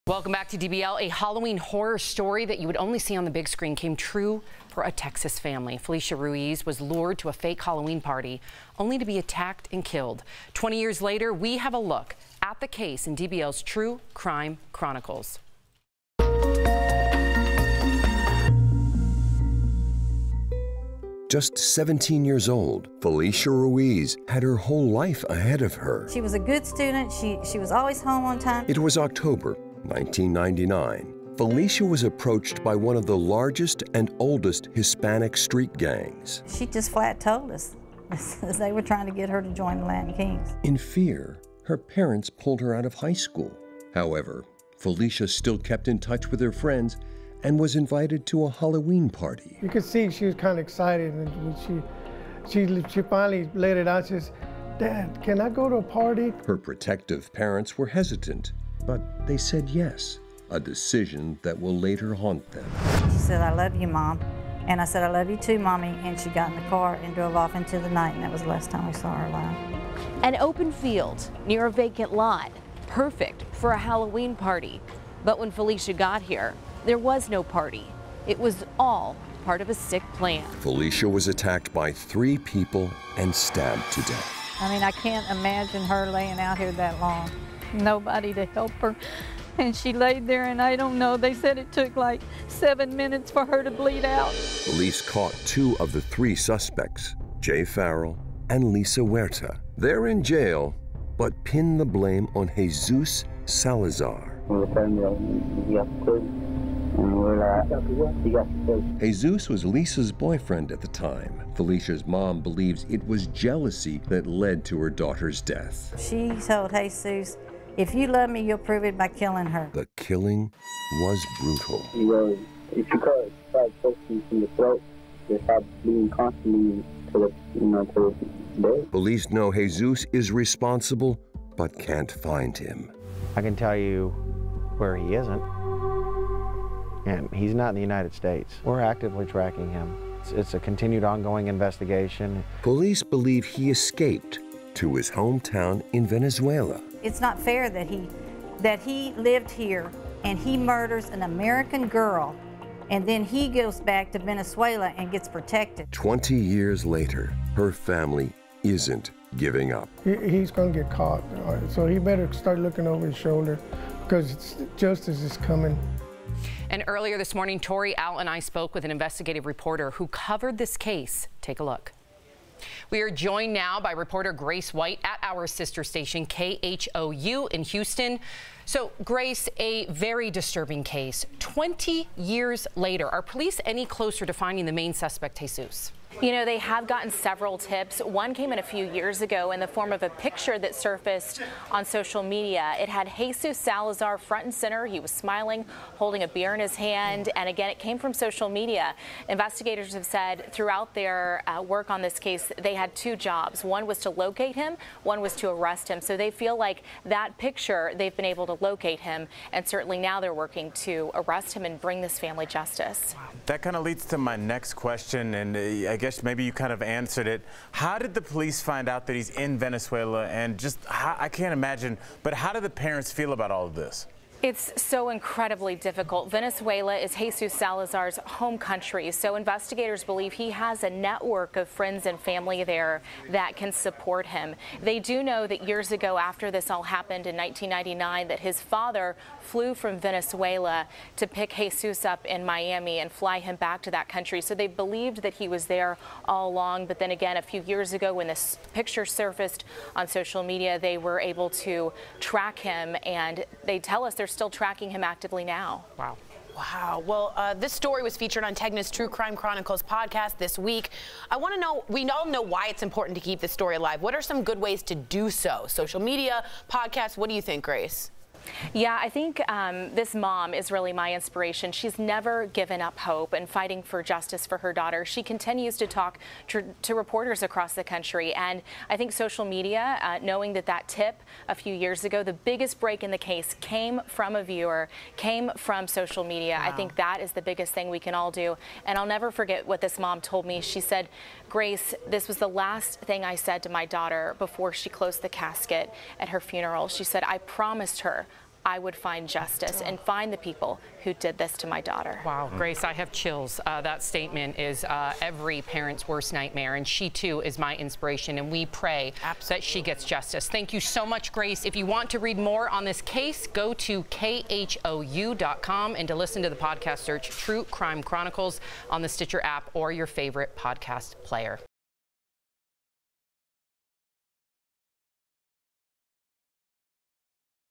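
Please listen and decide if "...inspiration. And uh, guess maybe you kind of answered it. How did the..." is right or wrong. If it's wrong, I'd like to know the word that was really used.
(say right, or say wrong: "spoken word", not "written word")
wrong: "question", not "inspiration".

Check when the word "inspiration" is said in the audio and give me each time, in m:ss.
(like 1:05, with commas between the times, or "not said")
4:31, 5:07.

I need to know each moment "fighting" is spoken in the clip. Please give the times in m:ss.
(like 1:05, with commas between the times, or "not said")
4:33.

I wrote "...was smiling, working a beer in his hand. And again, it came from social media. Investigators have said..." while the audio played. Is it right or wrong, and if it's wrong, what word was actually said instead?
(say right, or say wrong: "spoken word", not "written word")
wrong: "holding", not "working".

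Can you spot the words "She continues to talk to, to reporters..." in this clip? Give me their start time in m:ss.
4:35.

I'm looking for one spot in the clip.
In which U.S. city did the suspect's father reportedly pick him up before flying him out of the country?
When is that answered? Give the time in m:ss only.
4:02.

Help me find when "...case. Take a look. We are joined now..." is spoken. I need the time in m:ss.
2:50.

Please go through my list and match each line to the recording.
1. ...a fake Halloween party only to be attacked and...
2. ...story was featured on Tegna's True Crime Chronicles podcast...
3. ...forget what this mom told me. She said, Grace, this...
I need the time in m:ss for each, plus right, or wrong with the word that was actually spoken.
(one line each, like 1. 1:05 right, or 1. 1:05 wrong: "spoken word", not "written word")
1. 0:07 right
2. 4:17 right
3. 4:49 right.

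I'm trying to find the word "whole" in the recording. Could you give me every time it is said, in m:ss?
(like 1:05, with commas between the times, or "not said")
0:24.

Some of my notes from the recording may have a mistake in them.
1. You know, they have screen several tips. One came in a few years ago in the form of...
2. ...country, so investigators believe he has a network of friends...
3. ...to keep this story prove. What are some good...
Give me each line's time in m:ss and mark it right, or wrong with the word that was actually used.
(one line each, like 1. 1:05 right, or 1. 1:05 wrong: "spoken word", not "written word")
1. 3:06 wrong: "gotten", not "screen"
2. 3:48 right
3. 4:23 wrong: "alive", not "prove".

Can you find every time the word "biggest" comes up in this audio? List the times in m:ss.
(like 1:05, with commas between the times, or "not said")
4:42, 4:47.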